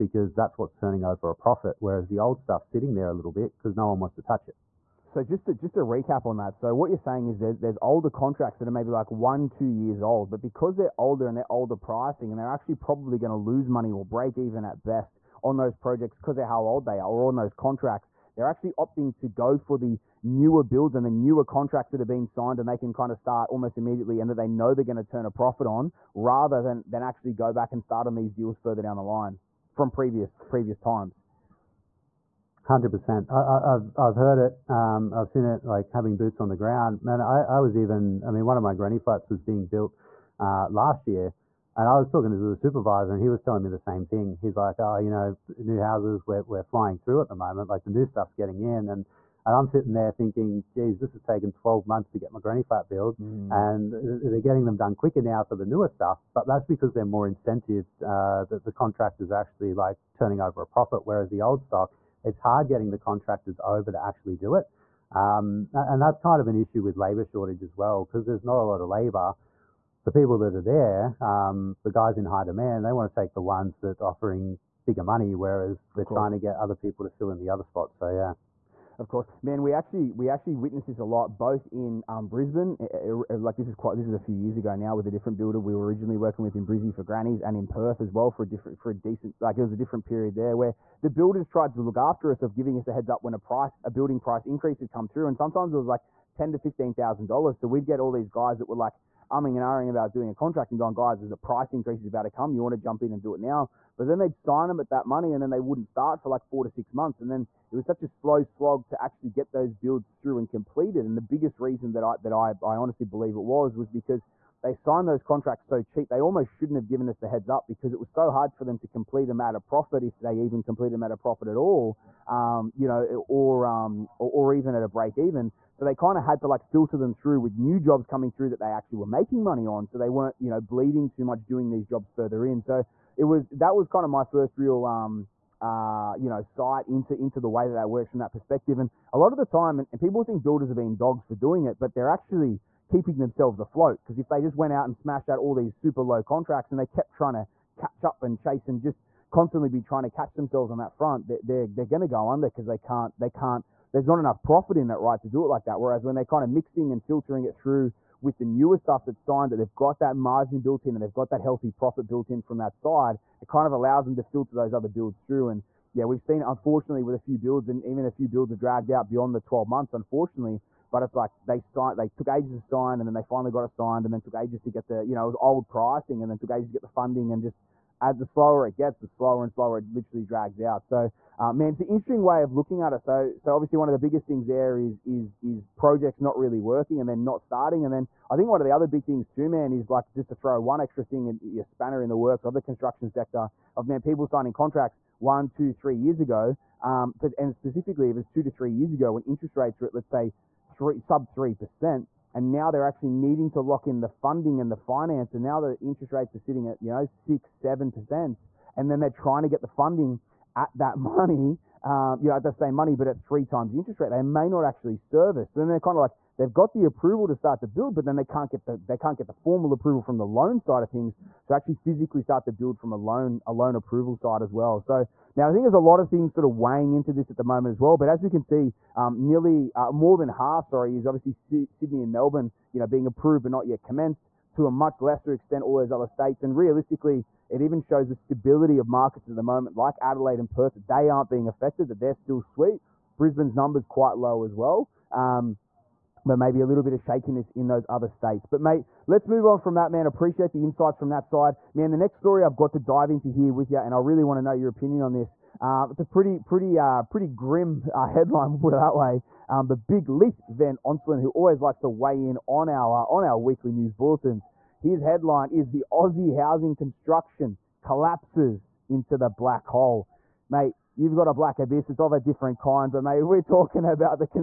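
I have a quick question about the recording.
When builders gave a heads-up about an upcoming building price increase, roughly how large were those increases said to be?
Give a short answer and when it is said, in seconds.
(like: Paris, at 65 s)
$10,000 to $15,000, at 96 s.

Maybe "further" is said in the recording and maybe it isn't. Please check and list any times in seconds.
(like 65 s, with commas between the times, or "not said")
28 s, 132 s.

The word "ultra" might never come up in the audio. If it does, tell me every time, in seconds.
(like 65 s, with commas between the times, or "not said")
not said.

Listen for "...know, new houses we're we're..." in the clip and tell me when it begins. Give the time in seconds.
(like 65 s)
45 s.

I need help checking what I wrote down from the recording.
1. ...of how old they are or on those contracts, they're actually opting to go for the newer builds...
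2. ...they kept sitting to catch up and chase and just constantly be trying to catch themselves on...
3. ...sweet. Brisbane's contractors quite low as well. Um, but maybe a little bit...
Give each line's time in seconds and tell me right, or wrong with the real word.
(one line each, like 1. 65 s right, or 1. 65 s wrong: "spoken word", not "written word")
1. 16 s right
2. 146 s wrong: "trying", not "sitting"
3. 242 s wrong: "numbers", not "contractors".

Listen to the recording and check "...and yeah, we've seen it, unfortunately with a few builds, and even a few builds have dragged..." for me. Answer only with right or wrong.
right.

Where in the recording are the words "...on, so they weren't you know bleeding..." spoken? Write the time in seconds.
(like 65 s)
129 s.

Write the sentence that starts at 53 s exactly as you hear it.
and they're getting them done quicker now for the newer stuff.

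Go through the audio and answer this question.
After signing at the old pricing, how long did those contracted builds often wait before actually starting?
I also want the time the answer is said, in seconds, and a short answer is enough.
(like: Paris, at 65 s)
4 to 6 months, at 106 s.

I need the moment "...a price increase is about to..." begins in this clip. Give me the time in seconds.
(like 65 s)
101 s.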